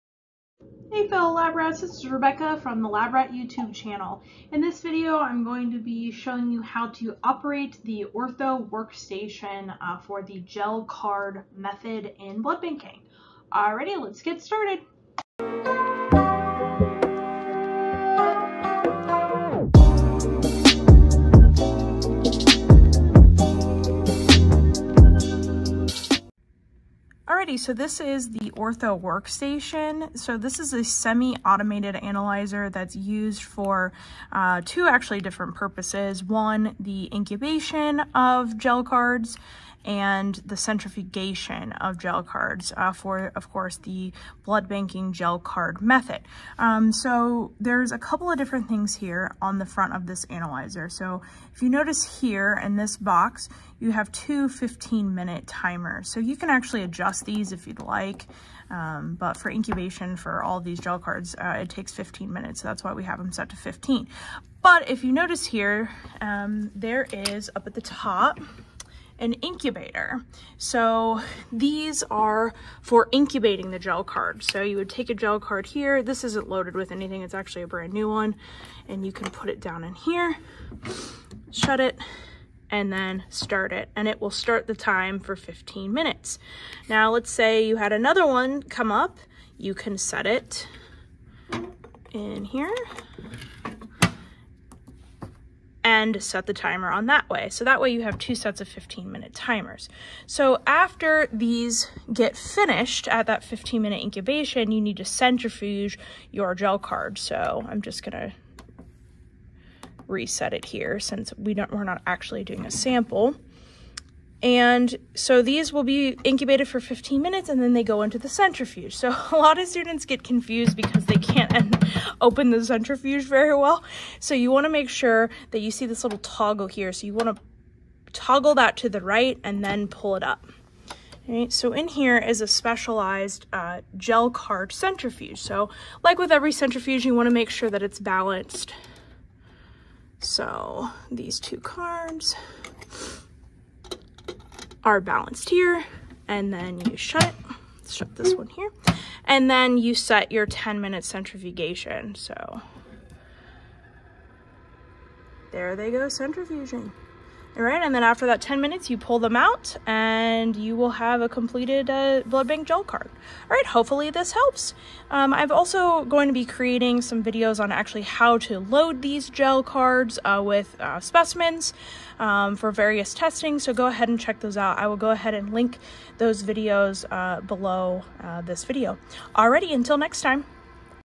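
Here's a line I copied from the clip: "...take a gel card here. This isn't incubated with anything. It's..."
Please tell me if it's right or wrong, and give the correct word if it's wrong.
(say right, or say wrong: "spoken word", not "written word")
wrong: "loaded", not "incubated".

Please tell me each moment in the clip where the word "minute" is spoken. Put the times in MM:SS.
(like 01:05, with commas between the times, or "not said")
00:55, 01:02, 01:25, 01:39, 01:43, 01:57, 02:30, 02:38.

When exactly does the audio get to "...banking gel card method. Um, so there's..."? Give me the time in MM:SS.
00:44.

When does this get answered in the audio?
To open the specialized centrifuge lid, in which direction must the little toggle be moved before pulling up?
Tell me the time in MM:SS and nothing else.
02:08.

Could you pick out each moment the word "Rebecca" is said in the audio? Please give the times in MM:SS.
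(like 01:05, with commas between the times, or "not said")
00:02.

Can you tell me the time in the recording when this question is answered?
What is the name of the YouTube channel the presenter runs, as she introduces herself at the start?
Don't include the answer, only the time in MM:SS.
00:02.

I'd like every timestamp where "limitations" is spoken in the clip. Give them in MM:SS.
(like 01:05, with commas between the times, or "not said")
not said.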